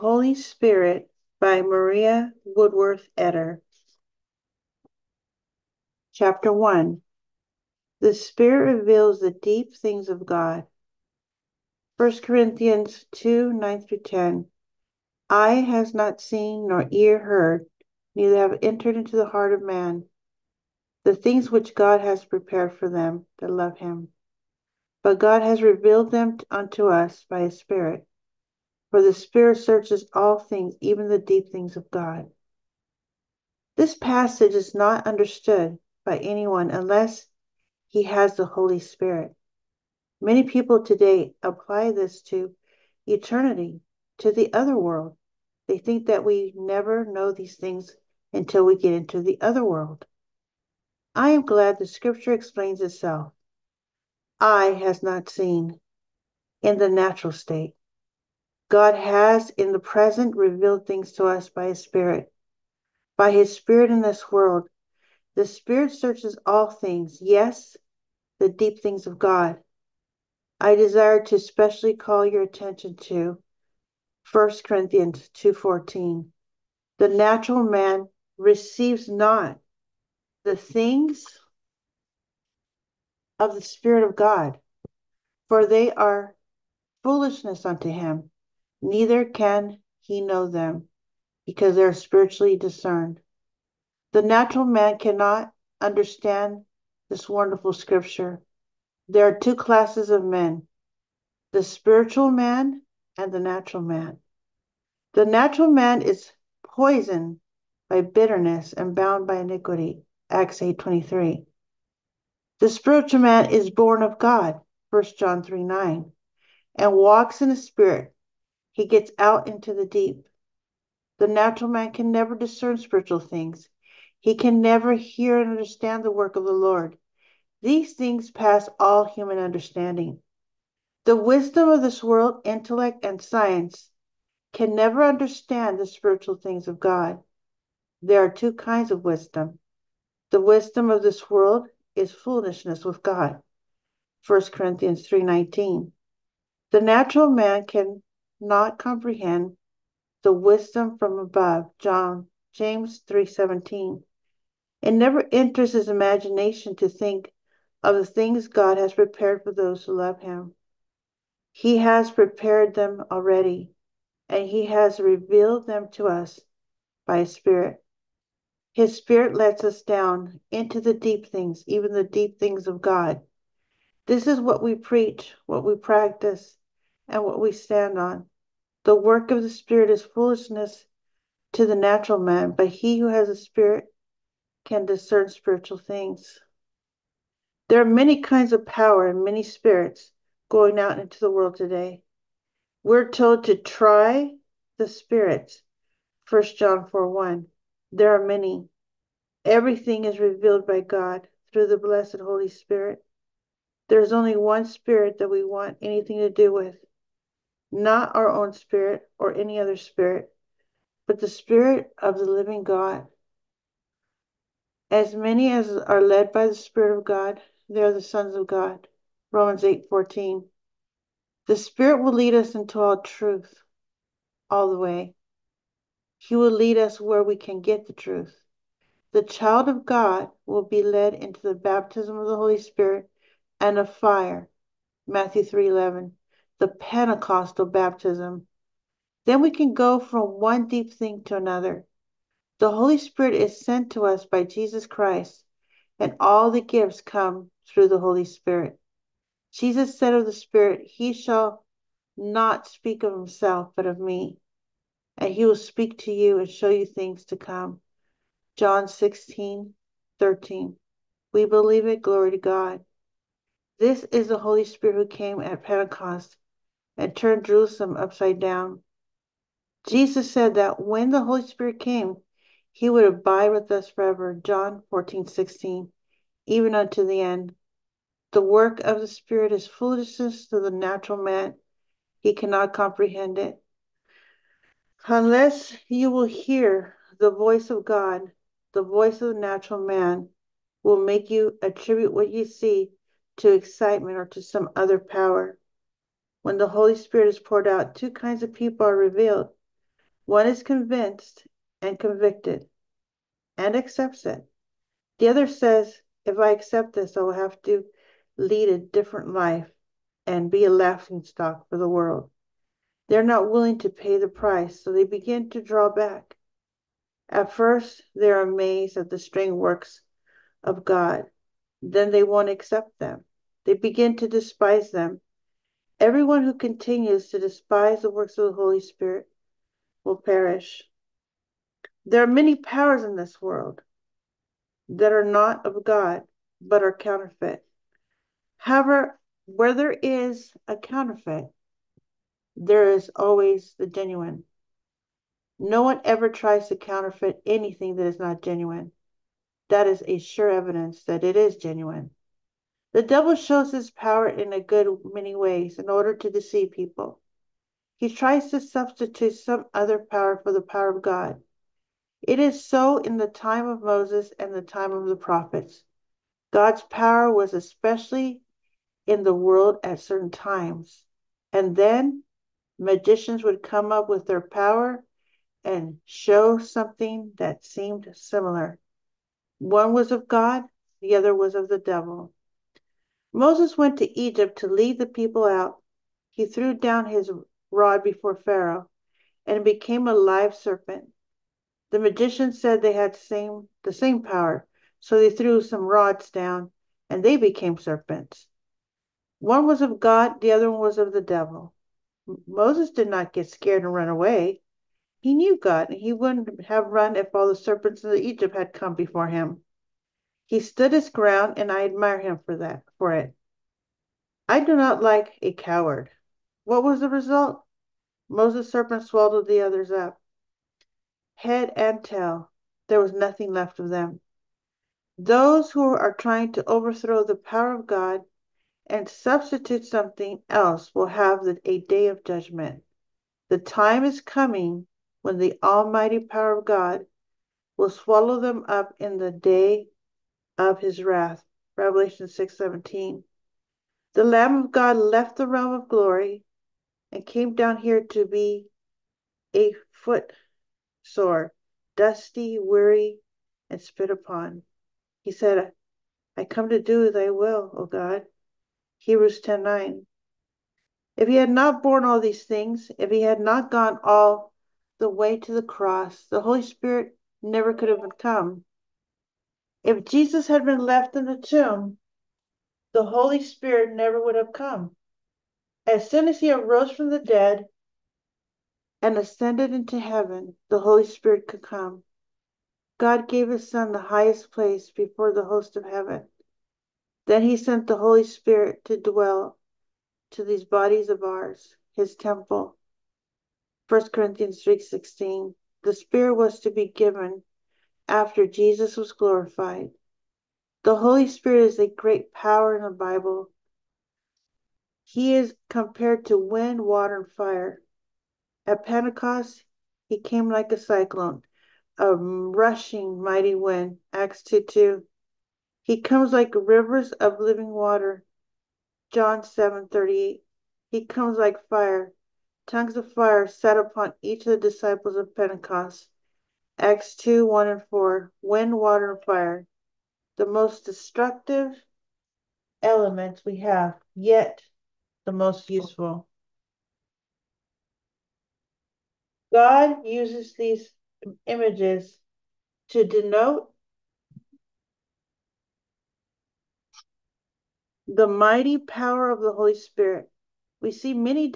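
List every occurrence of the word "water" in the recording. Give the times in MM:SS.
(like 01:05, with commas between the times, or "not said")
08:26, 08:37, 08:48.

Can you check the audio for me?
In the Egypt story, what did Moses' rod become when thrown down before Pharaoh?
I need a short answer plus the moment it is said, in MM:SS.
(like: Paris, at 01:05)
a live serpent, at 06:30.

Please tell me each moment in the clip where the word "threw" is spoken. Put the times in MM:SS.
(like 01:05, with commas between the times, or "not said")
06:26, 06:35.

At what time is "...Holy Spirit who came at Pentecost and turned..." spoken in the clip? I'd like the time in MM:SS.
04:24.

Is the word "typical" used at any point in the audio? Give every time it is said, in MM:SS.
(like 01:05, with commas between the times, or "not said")
not said.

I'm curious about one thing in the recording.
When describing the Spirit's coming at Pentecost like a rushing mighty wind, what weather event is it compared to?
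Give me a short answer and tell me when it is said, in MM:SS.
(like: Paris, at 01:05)
a cyclone, at 08:30.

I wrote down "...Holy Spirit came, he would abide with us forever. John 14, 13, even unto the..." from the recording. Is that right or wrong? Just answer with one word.
wrong.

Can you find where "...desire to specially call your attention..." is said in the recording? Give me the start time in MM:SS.
01:10.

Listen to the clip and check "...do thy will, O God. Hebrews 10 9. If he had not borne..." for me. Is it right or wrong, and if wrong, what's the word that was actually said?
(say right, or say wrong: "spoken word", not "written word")
right.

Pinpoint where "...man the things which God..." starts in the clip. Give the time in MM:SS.
00:19.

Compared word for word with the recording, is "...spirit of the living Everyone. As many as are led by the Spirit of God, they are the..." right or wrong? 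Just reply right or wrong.
wrong.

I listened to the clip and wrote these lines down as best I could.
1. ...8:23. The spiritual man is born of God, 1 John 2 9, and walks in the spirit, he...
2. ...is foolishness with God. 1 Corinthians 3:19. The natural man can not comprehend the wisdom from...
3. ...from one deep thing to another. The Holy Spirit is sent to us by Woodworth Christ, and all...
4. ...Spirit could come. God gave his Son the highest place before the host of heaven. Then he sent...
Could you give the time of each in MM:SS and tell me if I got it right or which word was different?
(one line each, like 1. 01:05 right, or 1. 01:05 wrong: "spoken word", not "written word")
1. 01:50 wrong: "3", not "2"
2. 02:21 right
3. 03:59 wrong: "Jesus", not "Woodworth"
4. 08:01 right.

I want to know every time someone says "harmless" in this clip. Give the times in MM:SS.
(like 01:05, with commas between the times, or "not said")
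not said.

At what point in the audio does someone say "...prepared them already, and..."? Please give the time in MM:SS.
02:42.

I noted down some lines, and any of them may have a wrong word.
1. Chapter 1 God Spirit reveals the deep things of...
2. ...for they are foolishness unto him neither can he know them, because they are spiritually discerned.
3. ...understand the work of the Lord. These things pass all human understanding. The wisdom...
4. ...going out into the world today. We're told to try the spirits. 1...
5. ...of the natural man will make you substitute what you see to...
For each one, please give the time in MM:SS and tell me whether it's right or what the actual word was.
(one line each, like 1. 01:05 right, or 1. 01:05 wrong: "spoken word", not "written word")
1. 00:06 wrong: "The", not "God"
2. 01:25 right
3. 02:05 right
4. 03:10 right
5. 04:49 wrong: "attribute", not "substitute".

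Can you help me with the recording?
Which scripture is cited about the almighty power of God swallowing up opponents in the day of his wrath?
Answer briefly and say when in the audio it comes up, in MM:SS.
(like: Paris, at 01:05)
Revelation 6:17, at 07:21.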